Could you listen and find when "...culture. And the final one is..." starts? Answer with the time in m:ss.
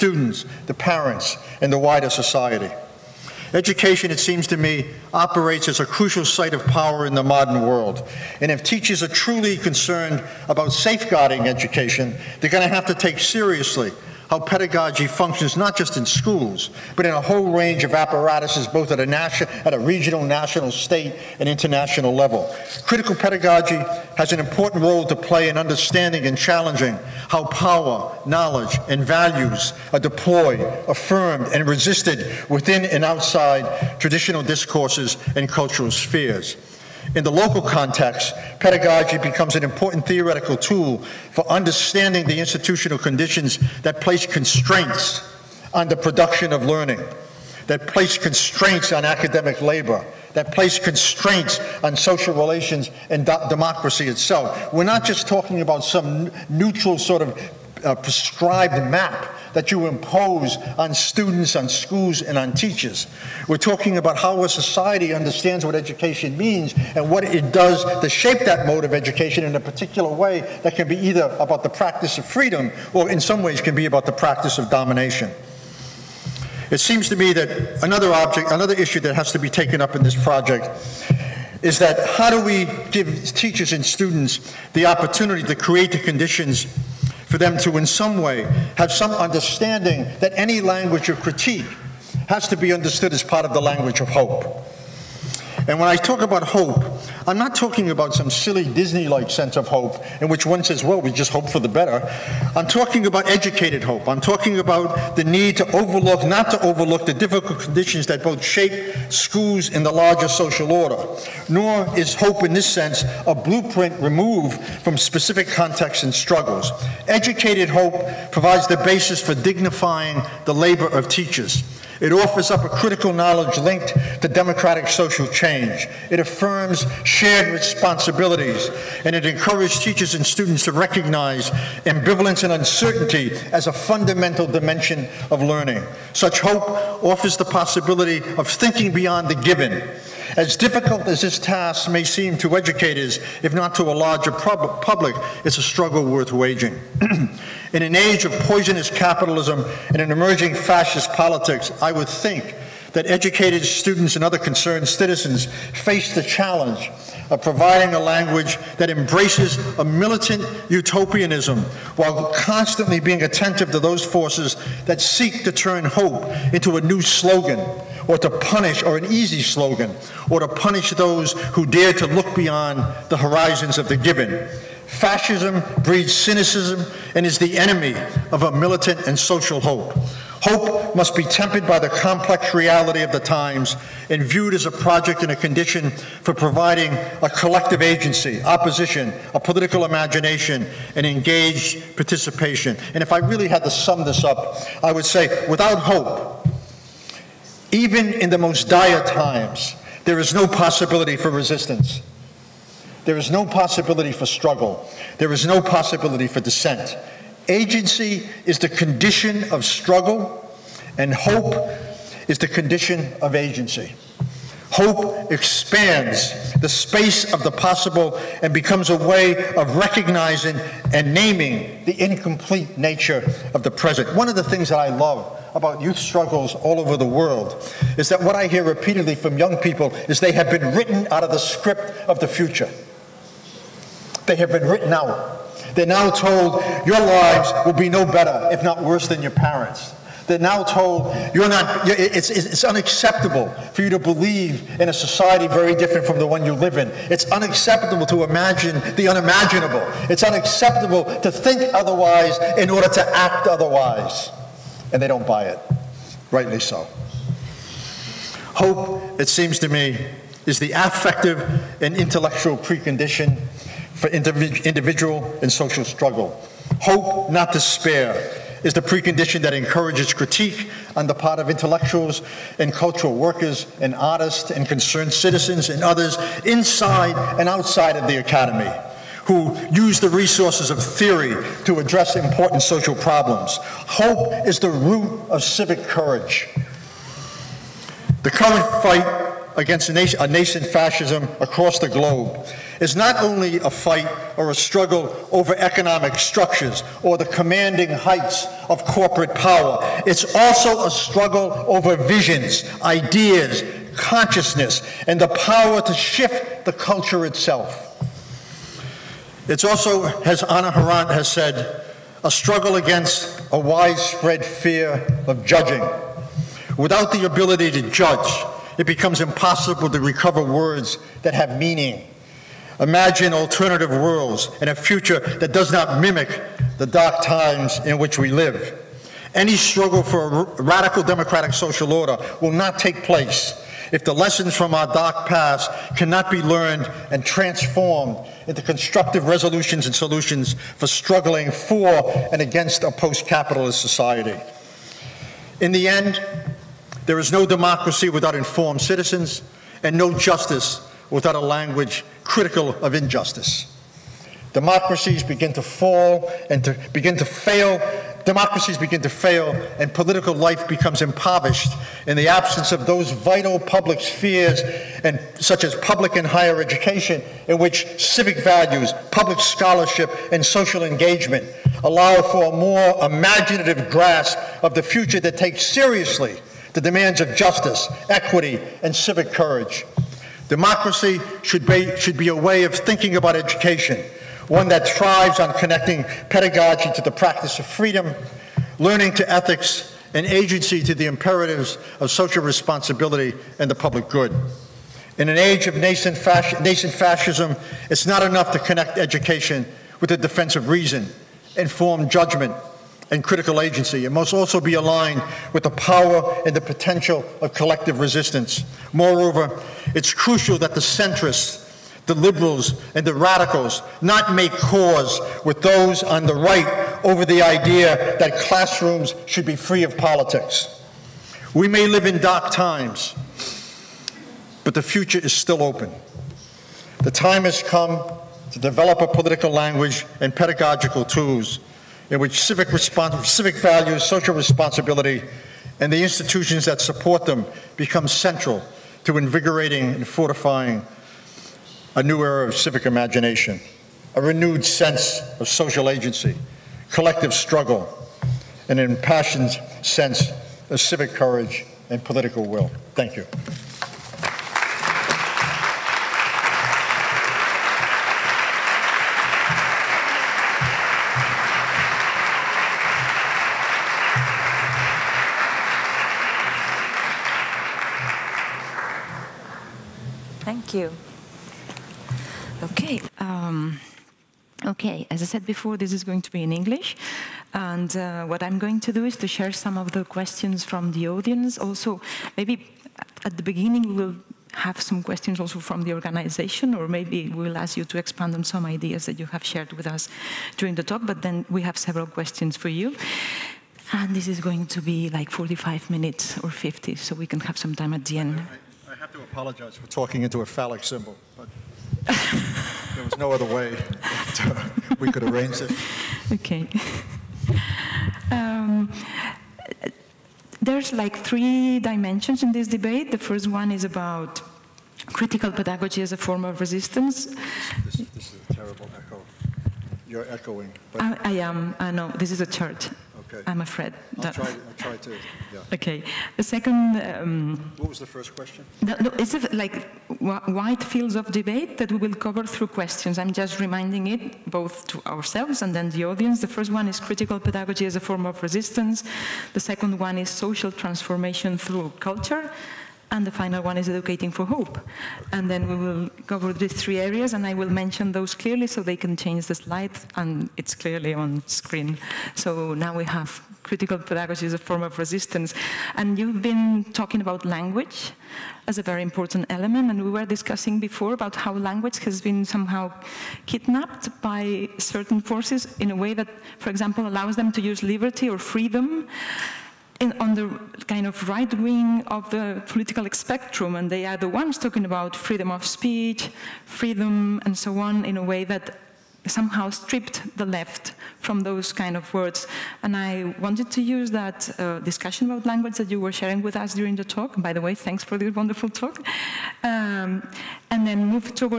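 9:01.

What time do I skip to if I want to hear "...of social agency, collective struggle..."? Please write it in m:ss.
7:25.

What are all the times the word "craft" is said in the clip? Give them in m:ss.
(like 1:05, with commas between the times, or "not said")
not said.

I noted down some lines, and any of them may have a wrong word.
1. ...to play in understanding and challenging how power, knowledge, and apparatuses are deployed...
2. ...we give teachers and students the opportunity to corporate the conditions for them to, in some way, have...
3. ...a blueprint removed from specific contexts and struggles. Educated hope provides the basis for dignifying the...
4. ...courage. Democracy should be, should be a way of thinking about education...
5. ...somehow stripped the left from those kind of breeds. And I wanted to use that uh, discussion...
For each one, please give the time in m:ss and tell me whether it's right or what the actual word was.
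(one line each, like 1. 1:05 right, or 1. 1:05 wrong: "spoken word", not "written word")
1. 0:25 wrong: "values", not "apparatuses"
2. 1:22 wrong: "create", not "corporate"
3. 1:53 right
4. 6:19 right
5. 9:39 wrong: "words", not "breeds".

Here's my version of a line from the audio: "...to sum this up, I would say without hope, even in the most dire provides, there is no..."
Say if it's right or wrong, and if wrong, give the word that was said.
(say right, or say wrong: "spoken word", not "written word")
wrong: "times", not "provides".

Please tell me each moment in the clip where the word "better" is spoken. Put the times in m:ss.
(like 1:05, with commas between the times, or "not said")
1:41, 3:58.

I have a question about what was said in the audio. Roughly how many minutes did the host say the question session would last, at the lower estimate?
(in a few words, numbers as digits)
45.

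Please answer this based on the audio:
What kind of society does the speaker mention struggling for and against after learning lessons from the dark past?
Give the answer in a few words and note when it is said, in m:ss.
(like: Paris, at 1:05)
Post-capitalist society, at 5:42.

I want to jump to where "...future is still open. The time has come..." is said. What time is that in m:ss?
7:04.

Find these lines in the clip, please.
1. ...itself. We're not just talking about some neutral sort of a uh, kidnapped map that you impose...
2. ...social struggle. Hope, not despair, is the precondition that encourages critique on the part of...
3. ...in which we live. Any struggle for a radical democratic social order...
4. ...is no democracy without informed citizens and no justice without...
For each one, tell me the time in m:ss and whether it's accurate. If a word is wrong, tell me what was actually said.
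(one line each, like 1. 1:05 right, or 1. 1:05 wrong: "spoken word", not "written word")
1. 0:54 wrong: "prescribed", not "kidnapped"
2. 4:25 right
3. 5:27 right
4. 5:47 right.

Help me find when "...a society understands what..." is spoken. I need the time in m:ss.
1:04.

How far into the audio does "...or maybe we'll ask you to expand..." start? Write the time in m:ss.
8:06.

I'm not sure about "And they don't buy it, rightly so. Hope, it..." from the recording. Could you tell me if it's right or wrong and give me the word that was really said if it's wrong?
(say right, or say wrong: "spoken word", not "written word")
right.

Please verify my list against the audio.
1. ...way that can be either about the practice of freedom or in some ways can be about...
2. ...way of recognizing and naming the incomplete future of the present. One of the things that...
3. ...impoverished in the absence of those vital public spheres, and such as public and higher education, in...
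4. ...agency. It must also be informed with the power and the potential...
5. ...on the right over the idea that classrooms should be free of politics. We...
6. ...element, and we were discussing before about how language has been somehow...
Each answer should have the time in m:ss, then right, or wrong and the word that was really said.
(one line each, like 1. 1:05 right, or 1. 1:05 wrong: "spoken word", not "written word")
1. 1:10 right
2. 3:38 wrong: "nature", not "future"
3. 6:01 right
4. 6:43 wrong: "aligned", not "informed"
5. 6:56 right
6. 9:19 right.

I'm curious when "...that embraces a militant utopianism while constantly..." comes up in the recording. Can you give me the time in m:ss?
2:38.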